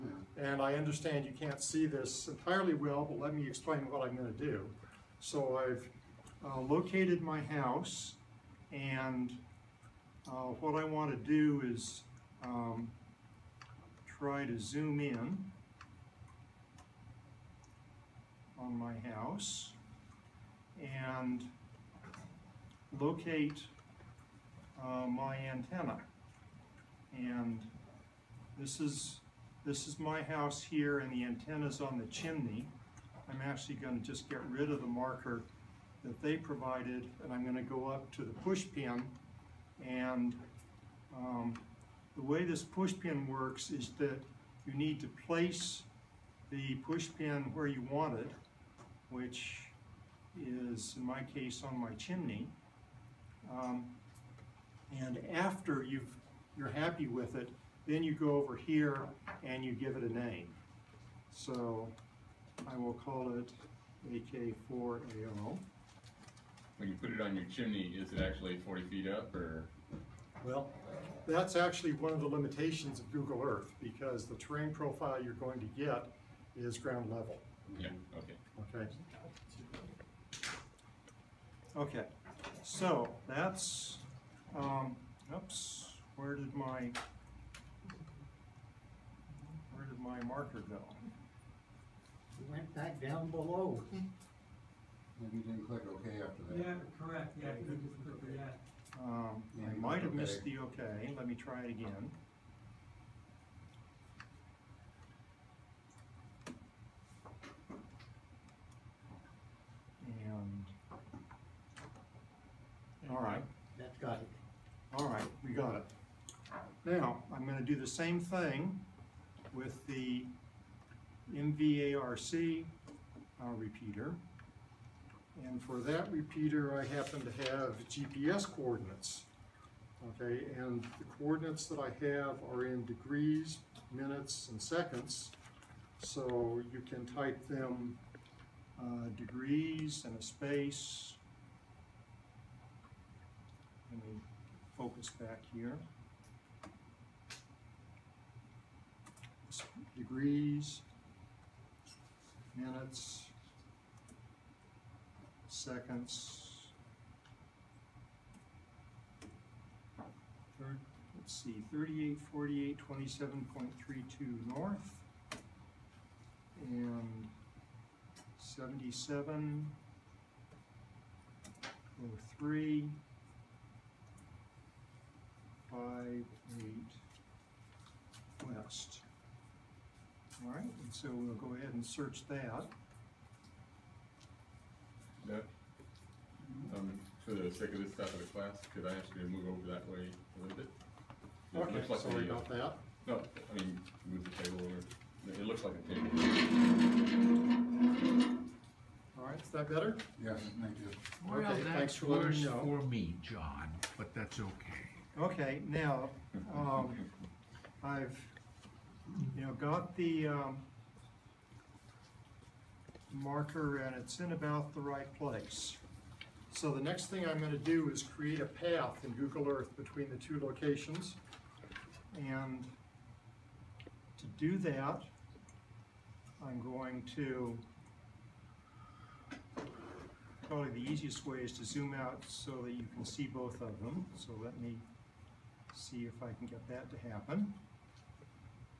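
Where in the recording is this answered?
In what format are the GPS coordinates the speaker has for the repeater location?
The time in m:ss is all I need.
2:12.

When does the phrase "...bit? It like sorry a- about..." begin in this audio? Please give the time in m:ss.
3:10.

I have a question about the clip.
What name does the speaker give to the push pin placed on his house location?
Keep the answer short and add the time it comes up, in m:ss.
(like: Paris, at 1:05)
AK4AO, at 1:04.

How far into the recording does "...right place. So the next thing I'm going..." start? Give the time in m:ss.
3:34.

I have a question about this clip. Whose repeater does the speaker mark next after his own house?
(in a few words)
MVARC.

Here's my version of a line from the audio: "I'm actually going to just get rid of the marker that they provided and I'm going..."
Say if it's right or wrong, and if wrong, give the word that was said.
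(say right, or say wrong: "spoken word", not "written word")
right.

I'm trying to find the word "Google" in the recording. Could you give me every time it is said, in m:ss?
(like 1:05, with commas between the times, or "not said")
1:13, 3:39.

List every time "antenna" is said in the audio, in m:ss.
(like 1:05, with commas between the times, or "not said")
0:25, 0:31.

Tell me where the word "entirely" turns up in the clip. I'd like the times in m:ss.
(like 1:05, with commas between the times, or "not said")
0:02.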